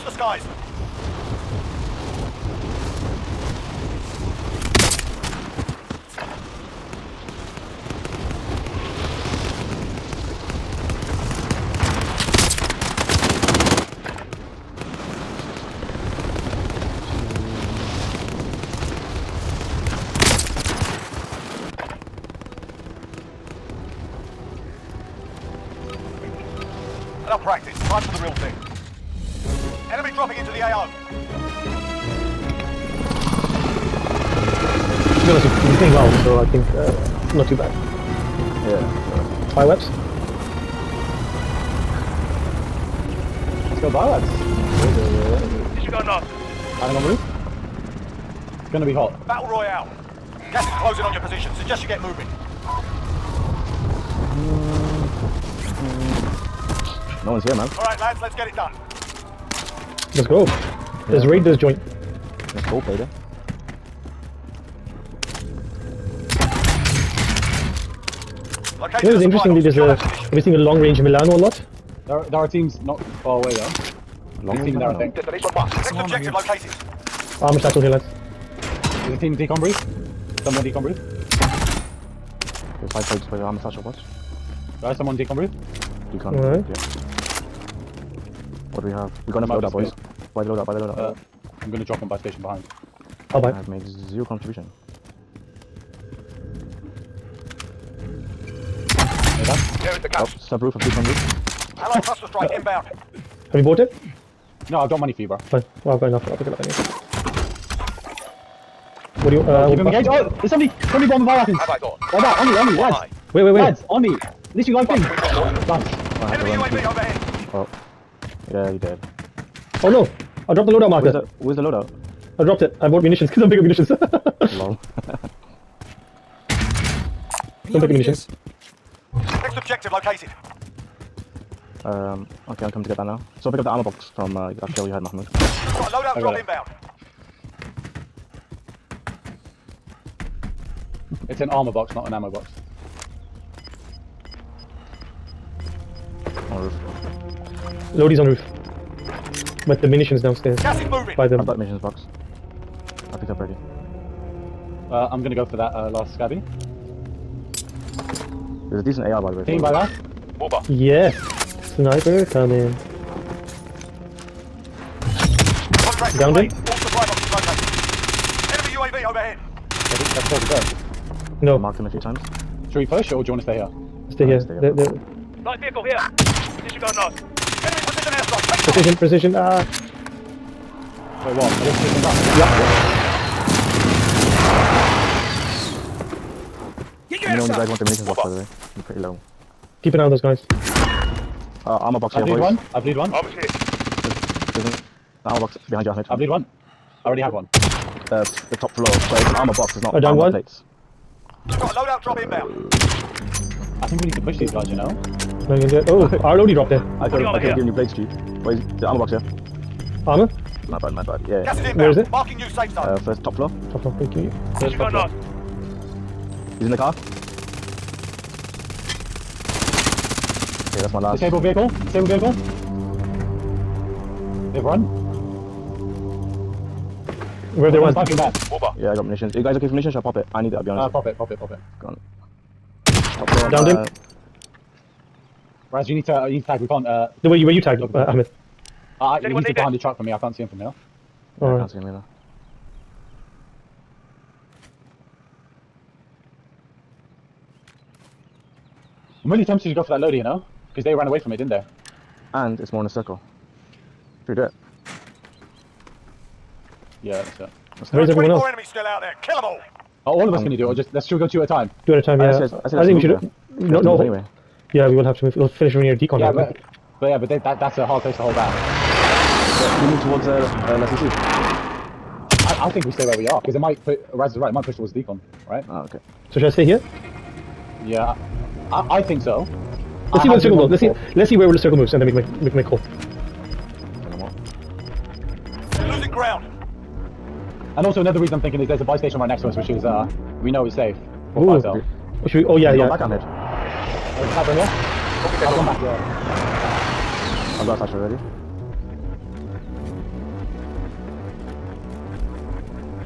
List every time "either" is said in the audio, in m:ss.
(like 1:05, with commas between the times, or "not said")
4:01.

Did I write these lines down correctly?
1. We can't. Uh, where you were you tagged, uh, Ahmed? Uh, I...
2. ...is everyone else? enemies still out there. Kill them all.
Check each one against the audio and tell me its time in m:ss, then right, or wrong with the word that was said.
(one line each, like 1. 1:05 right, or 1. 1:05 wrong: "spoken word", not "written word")
1. 3:56 right
2. 4:18 right.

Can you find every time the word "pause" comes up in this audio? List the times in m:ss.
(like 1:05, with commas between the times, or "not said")
not said.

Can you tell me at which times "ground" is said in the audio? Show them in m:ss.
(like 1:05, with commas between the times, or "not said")
4:46.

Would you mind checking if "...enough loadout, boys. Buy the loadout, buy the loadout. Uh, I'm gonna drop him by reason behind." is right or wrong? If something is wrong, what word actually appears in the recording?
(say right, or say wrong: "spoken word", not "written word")
wrong: "station", not "reason".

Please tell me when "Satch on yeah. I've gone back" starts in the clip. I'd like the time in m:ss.
4:53.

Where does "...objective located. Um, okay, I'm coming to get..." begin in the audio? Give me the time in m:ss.
2:09.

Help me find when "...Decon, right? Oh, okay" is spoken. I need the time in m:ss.
4:34.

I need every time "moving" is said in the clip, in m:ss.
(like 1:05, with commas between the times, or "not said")
0:52, 2:30.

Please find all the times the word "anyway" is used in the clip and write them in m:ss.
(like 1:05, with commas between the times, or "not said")
1:46, 4:24.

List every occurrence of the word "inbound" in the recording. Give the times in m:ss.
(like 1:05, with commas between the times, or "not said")
1:42, 2:16, 3:22.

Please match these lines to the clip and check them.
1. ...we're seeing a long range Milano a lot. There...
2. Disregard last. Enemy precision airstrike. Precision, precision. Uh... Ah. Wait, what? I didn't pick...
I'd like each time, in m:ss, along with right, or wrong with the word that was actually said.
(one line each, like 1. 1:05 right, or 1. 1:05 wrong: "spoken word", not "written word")
1. 1:10 right
2. 2:56 right.